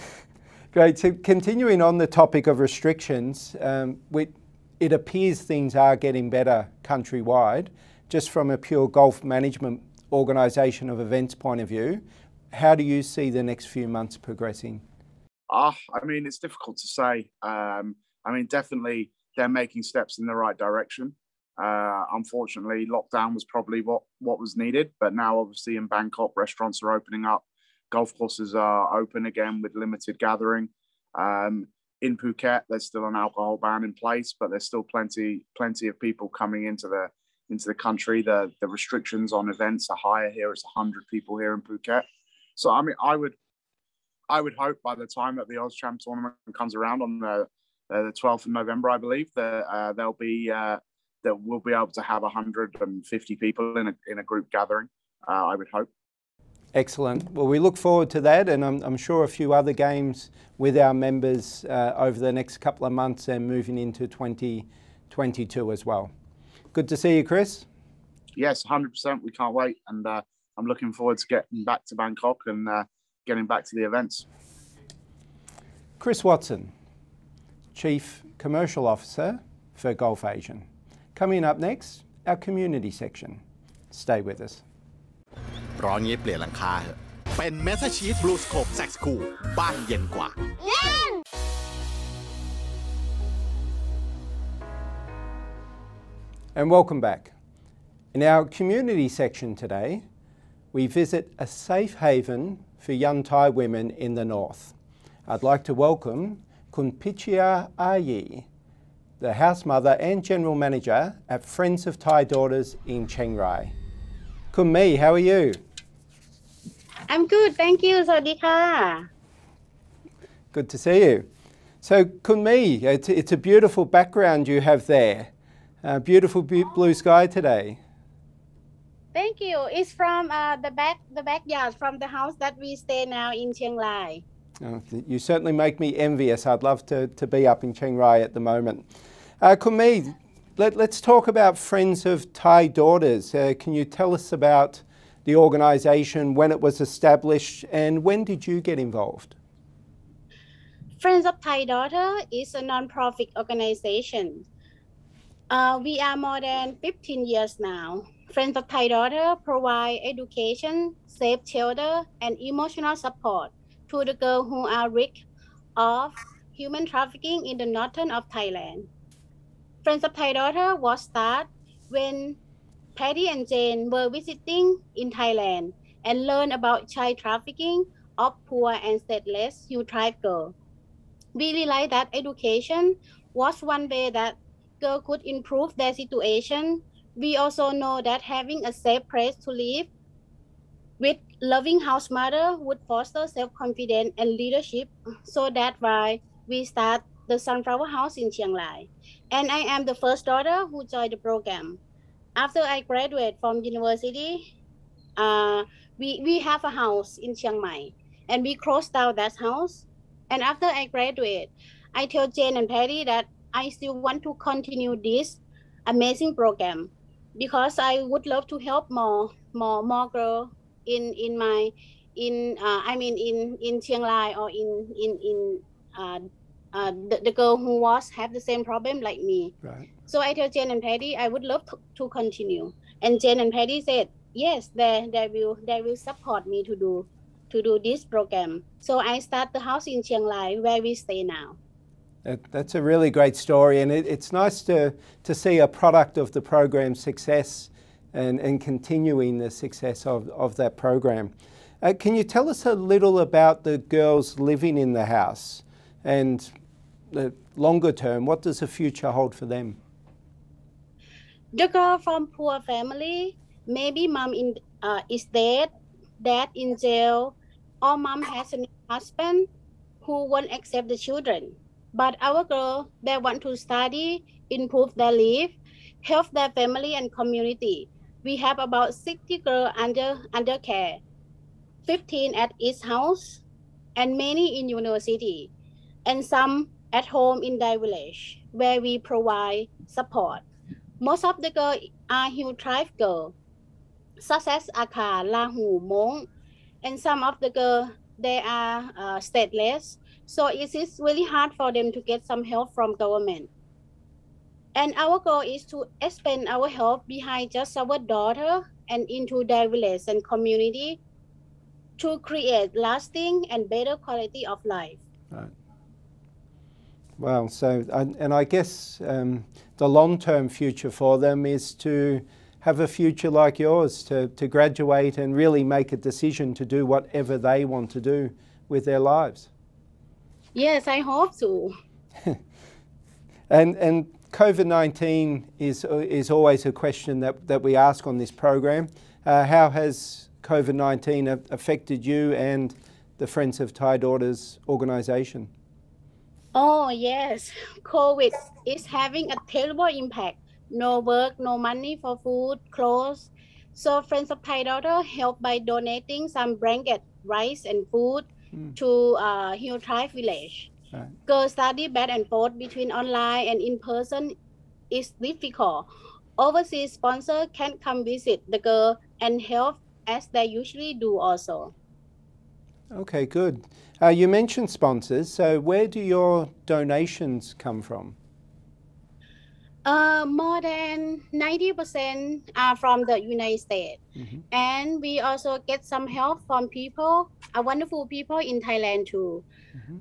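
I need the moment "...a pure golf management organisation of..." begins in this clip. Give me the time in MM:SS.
00:08.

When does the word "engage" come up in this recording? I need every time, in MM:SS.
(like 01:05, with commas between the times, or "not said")
not said.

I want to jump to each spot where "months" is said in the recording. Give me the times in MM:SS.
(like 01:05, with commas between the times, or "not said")
00:13, 01:02.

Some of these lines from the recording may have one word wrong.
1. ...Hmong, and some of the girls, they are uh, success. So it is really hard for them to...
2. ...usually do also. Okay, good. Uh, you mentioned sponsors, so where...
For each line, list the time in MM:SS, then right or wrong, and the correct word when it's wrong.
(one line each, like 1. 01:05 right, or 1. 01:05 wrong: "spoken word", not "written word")
1. 04:55 wrong: "stateless", not "success"
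2. 06:10 right.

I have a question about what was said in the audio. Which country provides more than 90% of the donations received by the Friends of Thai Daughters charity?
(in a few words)
United States.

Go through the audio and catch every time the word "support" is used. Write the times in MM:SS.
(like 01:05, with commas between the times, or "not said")
02:42, 03:55, 04:49.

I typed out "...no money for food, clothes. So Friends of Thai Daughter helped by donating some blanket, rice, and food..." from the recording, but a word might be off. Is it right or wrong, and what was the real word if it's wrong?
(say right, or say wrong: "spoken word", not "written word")
right.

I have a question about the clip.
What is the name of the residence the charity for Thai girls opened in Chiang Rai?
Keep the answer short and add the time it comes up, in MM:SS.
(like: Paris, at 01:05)
Sunflower House, at 03:17.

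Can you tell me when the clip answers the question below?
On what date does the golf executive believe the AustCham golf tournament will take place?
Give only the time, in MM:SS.
00:48.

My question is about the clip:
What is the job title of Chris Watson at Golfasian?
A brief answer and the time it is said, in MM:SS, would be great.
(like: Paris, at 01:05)
Chief Commercial Officer, at 01:17.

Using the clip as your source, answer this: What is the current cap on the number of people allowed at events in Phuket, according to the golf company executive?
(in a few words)
100.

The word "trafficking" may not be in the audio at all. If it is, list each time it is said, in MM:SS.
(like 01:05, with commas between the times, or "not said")
02:46, 02:57.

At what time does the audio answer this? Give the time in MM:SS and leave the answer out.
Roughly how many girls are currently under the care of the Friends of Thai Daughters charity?
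04:38.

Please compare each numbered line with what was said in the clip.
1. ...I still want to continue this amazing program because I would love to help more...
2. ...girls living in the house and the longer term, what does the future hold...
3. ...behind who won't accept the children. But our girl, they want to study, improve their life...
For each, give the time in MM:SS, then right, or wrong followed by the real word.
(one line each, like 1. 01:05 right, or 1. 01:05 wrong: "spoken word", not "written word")
1. 03:33 right
2. 04:13 right
3. 04:28 wrong: "husband", not "behind".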